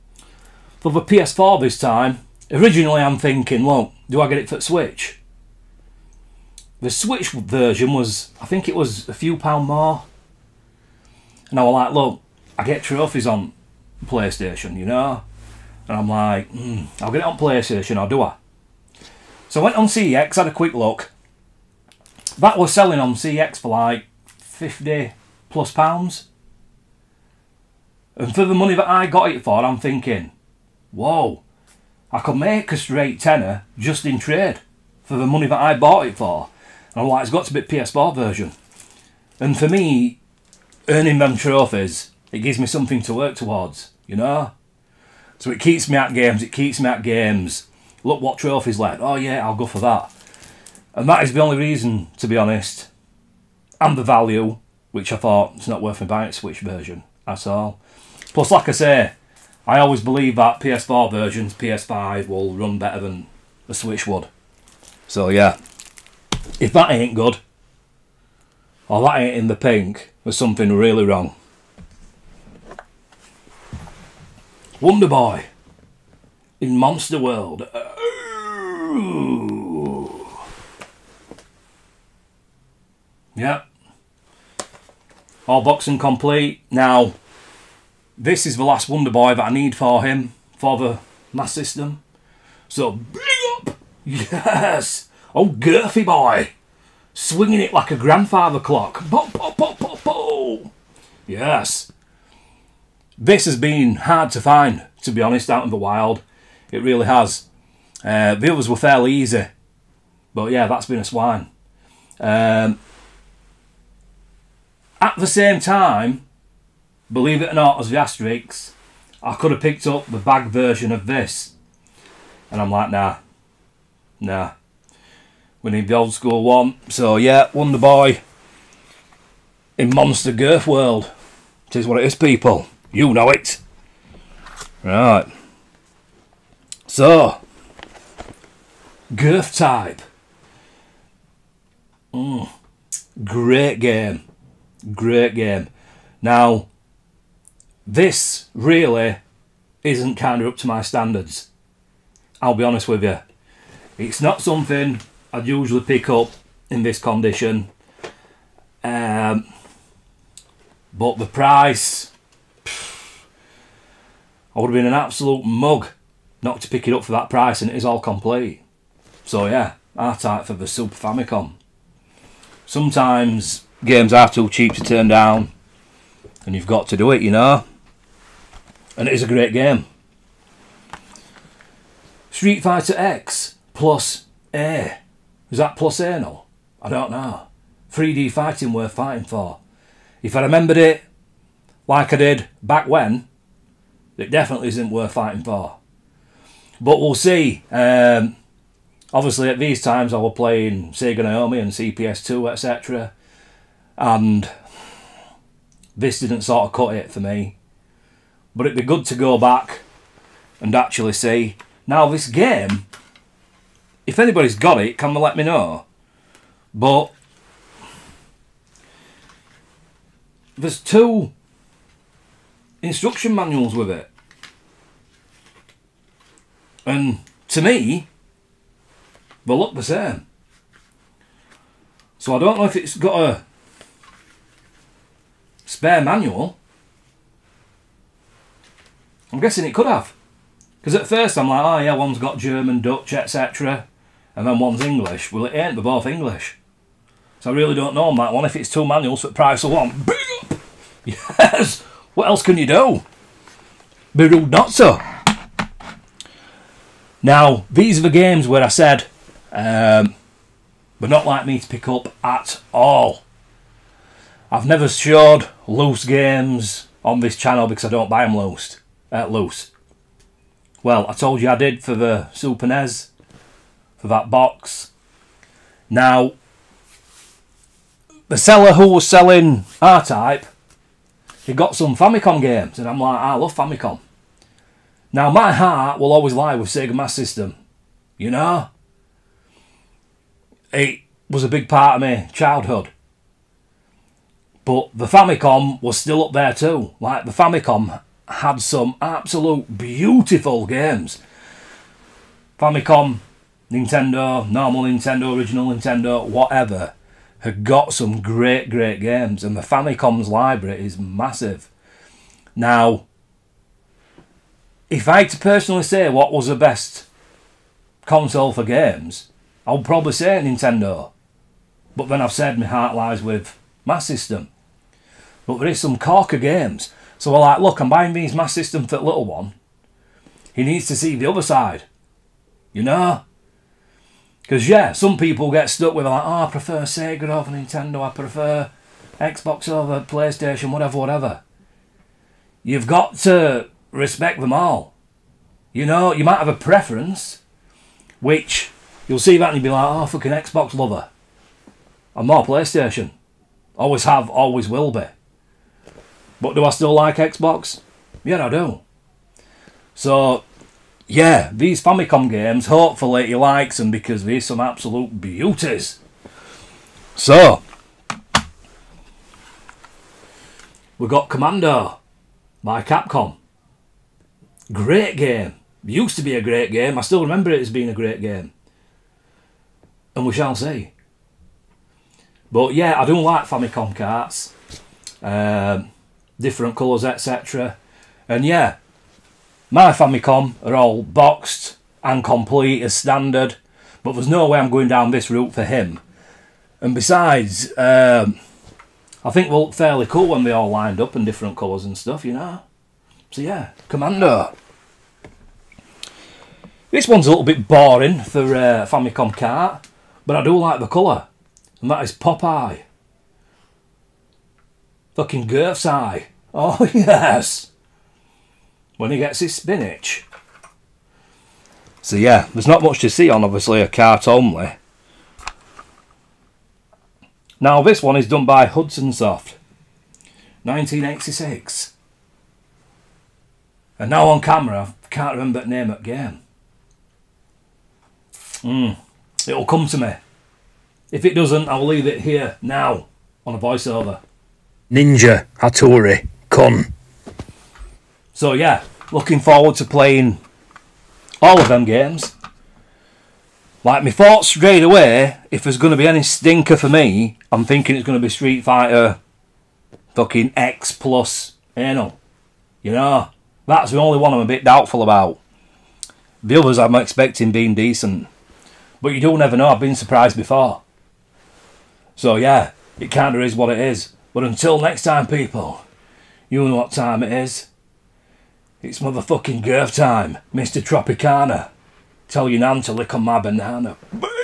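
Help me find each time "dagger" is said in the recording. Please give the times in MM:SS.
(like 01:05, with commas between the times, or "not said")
not said.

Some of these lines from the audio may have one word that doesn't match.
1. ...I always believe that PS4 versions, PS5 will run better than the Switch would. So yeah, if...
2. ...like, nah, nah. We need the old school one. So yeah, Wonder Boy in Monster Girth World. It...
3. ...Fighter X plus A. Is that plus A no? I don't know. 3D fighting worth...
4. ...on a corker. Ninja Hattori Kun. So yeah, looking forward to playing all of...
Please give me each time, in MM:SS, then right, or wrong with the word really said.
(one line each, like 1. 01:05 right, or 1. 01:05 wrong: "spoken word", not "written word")
1. 00:59 right
2. 02:02 right
3. 03:02 right
4. 07:23 wrong: "voiceover", not "corker".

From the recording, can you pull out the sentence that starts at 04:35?
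Now, the seller who was selling R-Type, he got some Famicom games, and I'm like, I love Famicom.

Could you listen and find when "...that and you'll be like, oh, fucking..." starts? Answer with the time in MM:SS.
05:49.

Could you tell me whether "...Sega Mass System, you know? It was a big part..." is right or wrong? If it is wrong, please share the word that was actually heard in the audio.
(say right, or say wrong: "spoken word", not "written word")
right.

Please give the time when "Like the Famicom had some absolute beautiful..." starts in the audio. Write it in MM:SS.
04:56.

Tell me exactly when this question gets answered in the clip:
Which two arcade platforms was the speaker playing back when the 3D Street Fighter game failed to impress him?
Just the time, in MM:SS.
03:20.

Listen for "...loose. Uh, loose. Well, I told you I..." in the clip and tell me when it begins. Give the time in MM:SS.
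04:28.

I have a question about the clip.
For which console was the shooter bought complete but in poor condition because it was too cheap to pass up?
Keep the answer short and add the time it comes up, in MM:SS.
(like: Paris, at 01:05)
Super Famicom, at 02:50.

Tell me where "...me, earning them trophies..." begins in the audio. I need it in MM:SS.
00:39.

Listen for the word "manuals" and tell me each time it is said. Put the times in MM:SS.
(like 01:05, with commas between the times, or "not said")
03:43, 03:56, 04:08.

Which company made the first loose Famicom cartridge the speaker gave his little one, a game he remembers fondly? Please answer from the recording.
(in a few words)
Capcom.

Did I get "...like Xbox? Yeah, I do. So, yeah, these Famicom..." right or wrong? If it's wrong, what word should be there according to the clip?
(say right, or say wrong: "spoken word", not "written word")
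right.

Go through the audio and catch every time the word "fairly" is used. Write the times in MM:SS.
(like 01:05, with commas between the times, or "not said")
01:48, 06:39.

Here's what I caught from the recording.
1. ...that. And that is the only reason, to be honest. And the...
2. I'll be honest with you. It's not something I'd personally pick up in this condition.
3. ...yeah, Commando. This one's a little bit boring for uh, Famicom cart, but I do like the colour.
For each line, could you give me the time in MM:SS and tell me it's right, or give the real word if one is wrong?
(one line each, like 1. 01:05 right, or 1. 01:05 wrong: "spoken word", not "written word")
1. 00:49 right
2. 02:32 wrong: "usually", not "personally"
3. 06:43 right.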